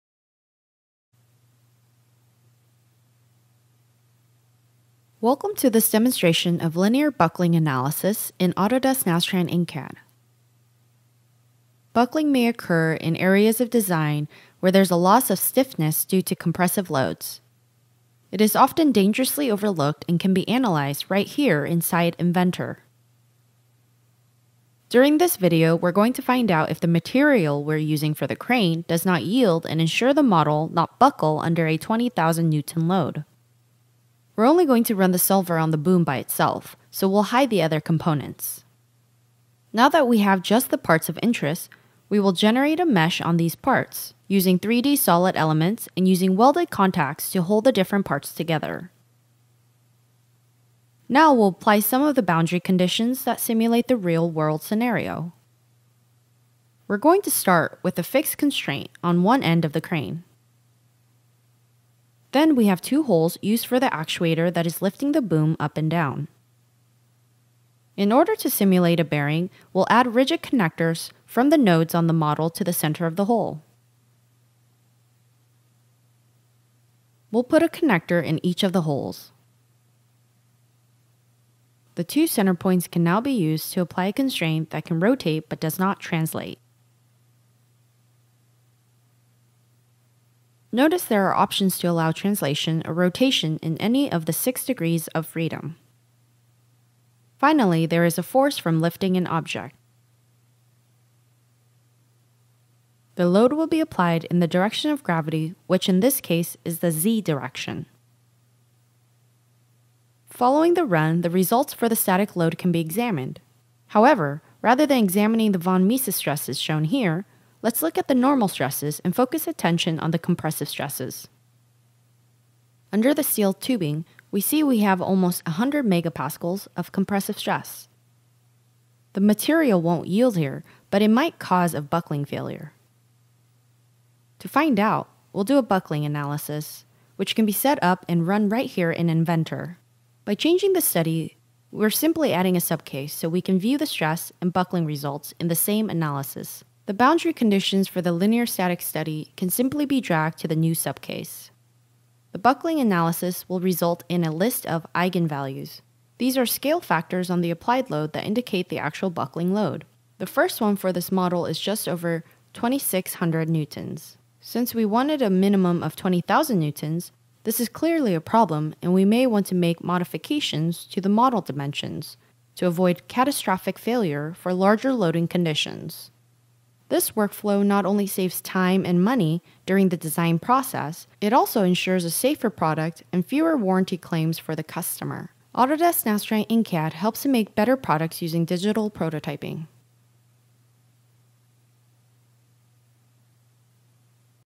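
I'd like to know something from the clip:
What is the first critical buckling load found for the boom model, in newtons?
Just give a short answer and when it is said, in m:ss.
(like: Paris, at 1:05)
just over 2600 newtons, at 2:41.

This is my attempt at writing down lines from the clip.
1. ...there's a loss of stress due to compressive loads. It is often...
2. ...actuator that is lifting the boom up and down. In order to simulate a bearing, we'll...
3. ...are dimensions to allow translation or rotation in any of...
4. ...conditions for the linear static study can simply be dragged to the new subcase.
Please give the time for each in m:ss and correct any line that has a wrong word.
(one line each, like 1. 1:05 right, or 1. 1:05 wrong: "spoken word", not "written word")
1. 0:14 wrong: "stiffness", not "stress"
2. 1:03 right
3. 1:31 wrong: "options", not "dimensions"
4. 2:27 right.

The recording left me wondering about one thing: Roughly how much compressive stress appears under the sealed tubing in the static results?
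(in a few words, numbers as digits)
100 megapascals.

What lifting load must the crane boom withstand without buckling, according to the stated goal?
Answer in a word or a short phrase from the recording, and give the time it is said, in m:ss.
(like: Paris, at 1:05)
20,000 newtons, at 0:31.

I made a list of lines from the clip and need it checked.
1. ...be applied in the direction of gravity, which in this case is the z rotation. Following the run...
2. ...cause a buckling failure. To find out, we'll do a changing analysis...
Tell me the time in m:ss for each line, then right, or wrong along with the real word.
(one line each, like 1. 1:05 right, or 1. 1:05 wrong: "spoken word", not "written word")
1. 1:43 wrong: "direction", not "rotation"
2. 2:11 wrong: "buckling", not "changing".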